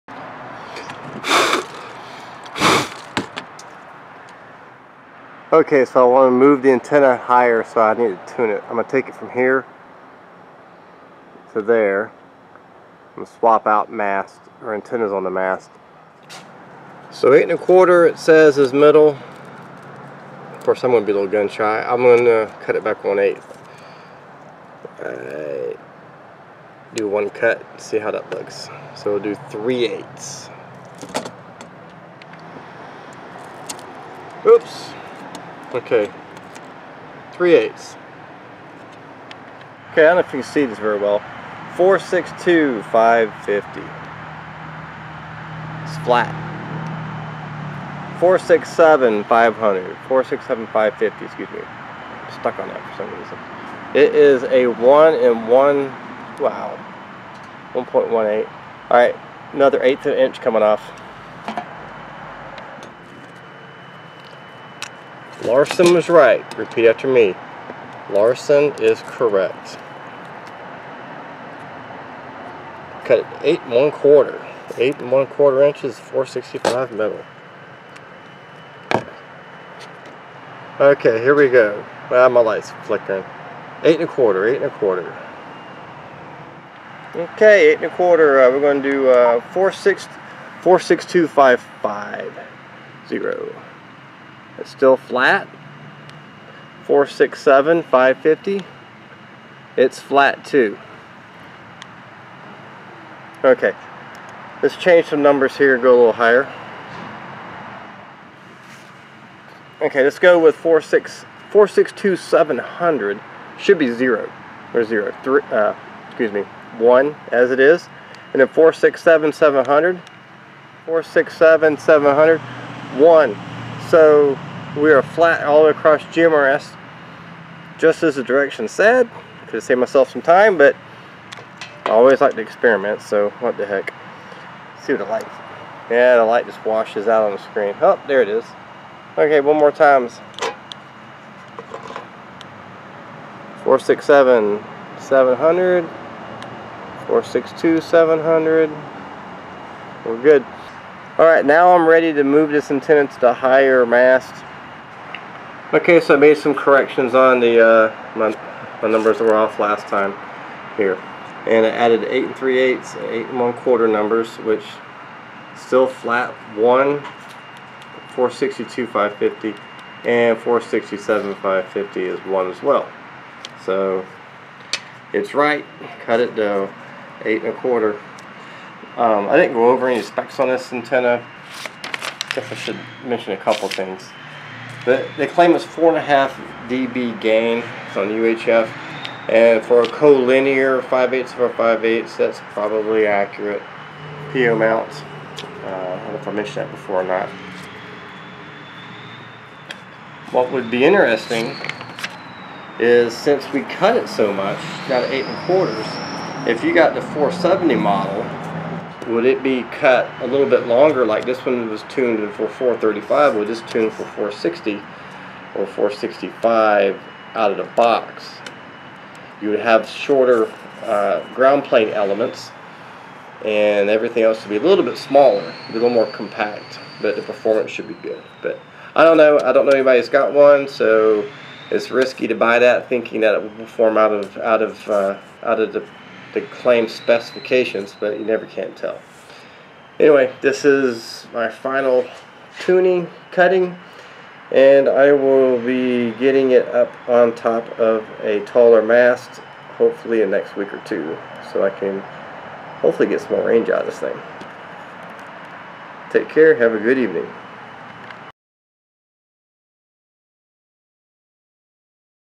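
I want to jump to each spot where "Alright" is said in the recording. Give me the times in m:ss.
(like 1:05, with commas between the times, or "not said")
0:58, 2:31.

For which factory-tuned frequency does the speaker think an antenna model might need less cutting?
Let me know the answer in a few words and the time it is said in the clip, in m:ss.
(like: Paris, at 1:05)
435, at 3:32.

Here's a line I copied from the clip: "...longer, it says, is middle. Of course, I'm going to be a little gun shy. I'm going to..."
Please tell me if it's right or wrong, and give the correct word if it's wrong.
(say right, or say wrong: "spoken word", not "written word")
wrong: "quarter", not "longer".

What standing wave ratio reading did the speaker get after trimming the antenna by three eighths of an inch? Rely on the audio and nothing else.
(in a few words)
1.18.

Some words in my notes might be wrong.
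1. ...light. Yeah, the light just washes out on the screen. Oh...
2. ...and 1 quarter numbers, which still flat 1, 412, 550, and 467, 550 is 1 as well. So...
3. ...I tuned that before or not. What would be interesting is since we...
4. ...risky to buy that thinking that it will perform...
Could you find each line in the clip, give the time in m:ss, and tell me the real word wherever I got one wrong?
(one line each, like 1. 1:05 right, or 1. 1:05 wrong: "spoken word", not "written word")
1. 2:15 right
2. 2:43 wrong: "462", not "412"
3. 3:16 wrong: "mentioned", not "tuned"
4. 3:51 right.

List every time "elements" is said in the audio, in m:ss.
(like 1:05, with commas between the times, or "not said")
3:41.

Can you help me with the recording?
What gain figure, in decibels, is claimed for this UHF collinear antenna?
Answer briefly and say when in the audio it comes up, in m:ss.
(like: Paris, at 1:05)
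4.5 dB, at 3:05.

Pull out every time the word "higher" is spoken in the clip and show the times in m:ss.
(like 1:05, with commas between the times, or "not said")
0:07, 1:46, 2:33.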